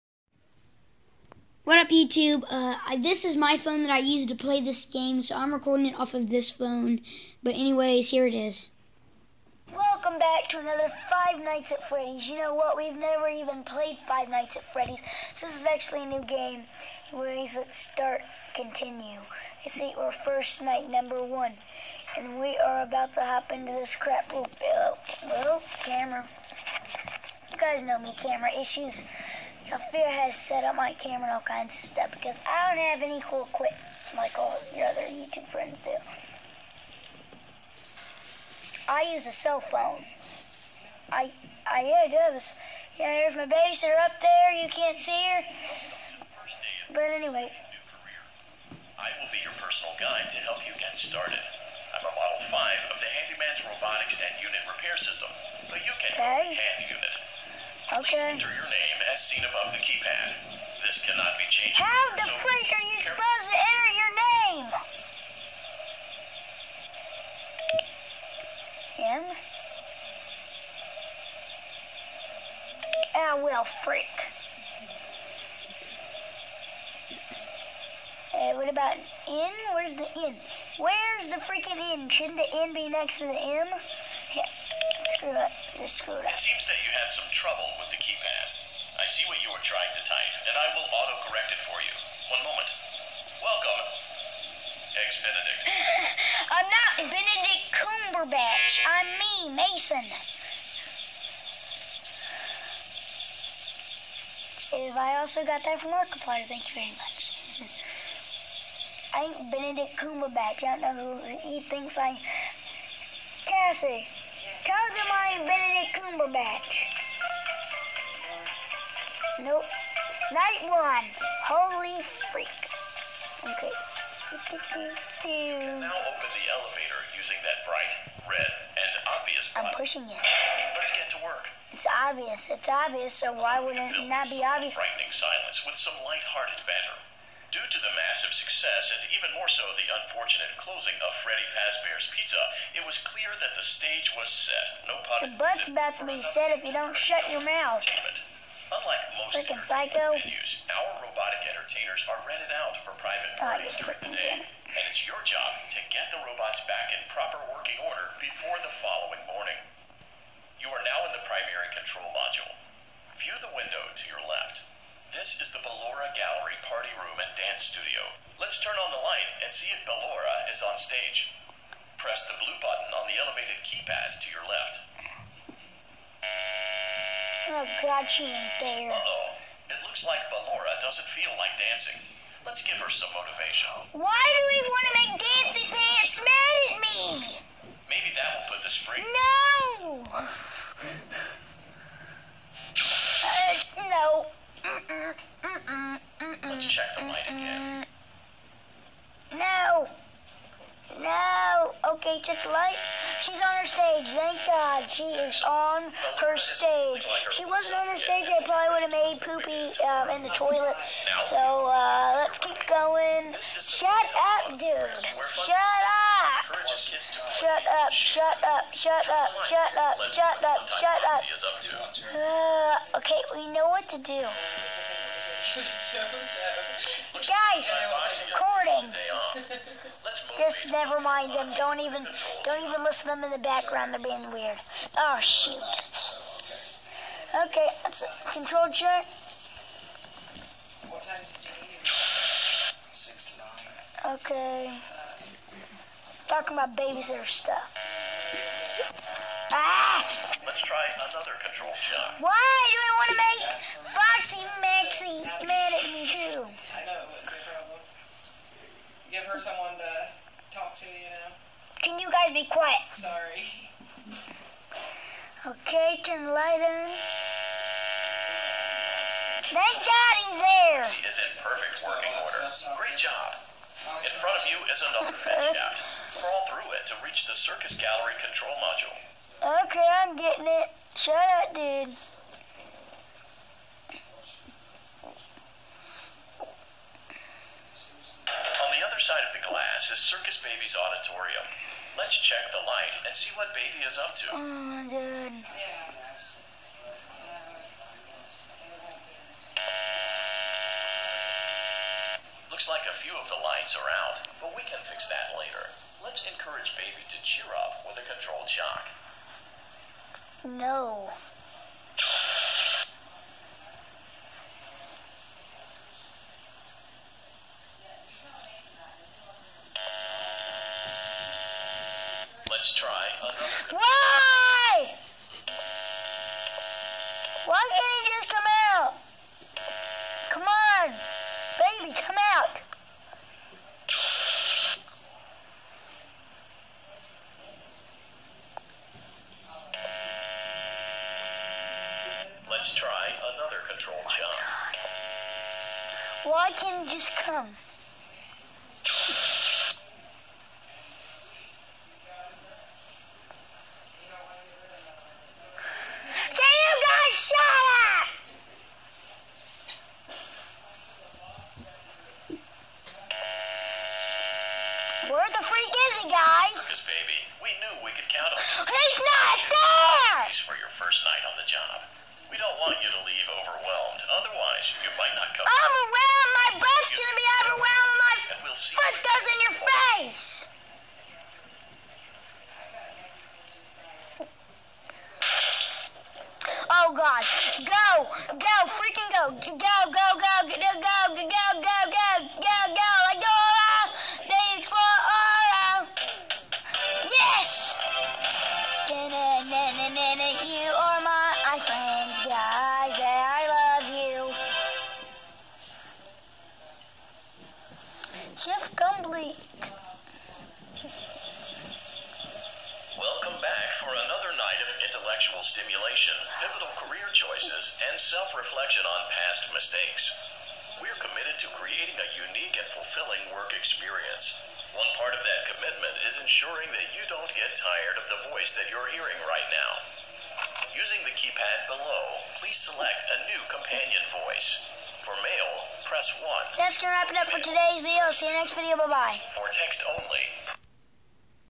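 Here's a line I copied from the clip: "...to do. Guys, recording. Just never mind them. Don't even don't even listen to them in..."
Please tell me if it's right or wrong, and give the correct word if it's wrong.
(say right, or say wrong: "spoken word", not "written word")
right.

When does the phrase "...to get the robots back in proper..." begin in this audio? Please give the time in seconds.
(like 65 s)
155 s.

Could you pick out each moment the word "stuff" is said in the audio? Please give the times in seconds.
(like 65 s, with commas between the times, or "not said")
31 s, 247 s.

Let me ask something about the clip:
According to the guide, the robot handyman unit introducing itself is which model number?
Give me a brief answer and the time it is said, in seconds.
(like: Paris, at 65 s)
5, at 52 s.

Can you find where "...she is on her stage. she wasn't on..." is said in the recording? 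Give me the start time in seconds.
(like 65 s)
204 s.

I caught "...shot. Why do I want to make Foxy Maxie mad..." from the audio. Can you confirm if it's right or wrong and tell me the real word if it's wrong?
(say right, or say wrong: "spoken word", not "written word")
right.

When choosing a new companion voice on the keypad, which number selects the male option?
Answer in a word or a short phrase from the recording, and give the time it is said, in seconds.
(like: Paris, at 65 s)
1, at 435 s.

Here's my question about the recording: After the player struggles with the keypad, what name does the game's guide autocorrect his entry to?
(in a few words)
Eggs Benedict.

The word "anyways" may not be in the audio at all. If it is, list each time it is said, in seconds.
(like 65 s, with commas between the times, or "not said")
7 s, 17 s, 47 s.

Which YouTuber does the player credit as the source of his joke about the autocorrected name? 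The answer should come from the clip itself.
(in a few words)
Markiplier.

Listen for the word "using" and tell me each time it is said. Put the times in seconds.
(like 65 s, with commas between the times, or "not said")
127 s, 430 s.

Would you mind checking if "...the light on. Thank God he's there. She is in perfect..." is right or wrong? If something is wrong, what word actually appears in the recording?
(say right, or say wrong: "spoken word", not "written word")
right.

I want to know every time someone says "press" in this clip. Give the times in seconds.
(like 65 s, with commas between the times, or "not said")
171 s, 435 s.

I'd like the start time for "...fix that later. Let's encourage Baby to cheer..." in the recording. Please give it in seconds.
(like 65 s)
304 s.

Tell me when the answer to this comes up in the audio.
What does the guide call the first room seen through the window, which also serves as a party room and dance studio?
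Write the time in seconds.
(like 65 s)
165 s.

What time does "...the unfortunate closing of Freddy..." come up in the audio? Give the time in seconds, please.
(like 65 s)
139 s.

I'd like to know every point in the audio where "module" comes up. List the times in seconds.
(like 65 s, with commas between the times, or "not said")
162 s, 278 s.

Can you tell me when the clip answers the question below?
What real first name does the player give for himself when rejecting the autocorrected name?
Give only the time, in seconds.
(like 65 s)
99 s.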